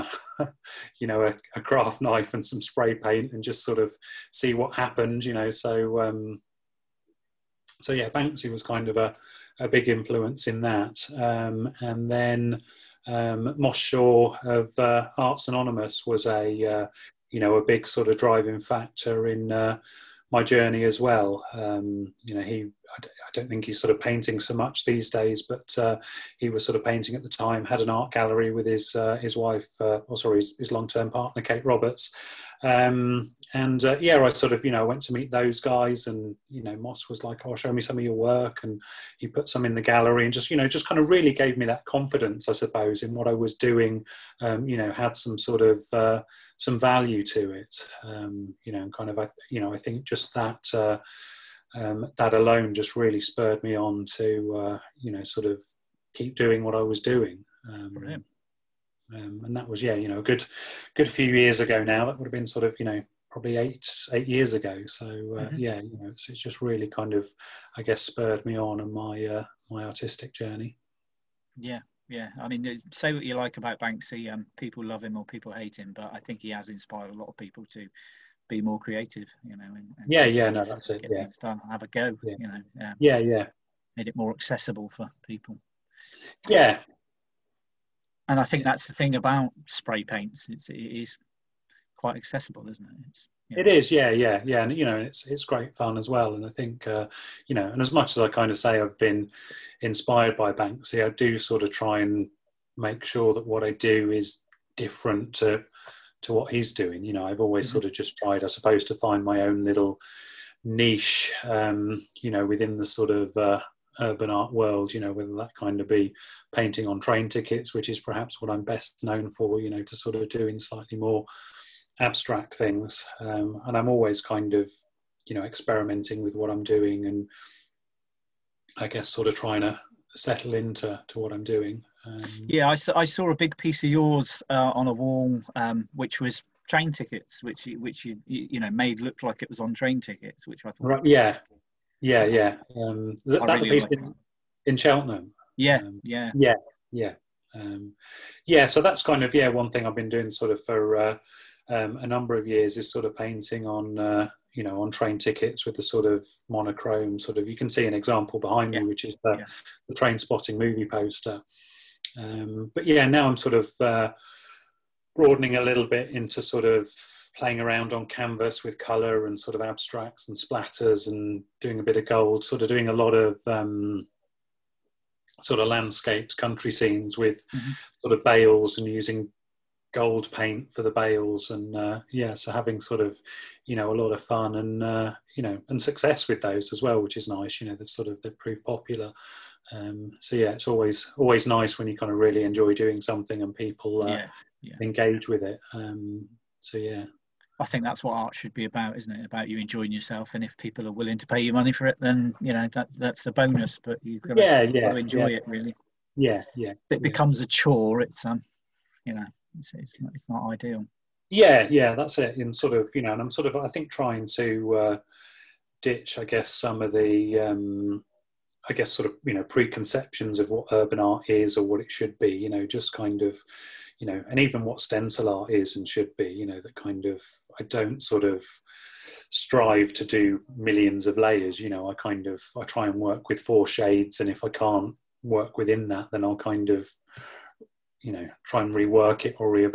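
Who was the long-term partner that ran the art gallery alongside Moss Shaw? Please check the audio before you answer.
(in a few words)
Kate Roberts.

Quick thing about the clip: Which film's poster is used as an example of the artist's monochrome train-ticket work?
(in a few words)
Trainspotting.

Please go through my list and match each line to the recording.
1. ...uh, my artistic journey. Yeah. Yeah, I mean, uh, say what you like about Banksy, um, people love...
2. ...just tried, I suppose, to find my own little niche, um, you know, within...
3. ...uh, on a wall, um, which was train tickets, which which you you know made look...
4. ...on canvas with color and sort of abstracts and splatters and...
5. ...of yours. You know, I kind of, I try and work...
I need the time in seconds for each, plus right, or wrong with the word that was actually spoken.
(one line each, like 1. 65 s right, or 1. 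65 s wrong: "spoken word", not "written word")
1. 69 s right
2. 107 s right
3. 134 s right
4. 167 s right
5. 231 s wrong: "layers", not "yours".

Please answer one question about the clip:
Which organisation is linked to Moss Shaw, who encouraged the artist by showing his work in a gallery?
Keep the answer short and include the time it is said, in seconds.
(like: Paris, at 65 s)
Arts Anonymous, at 15 s.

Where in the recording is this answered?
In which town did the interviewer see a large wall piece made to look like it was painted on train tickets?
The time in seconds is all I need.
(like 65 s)
144 s.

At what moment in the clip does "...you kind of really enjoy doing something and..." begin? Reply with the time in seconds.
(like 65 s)
191 s.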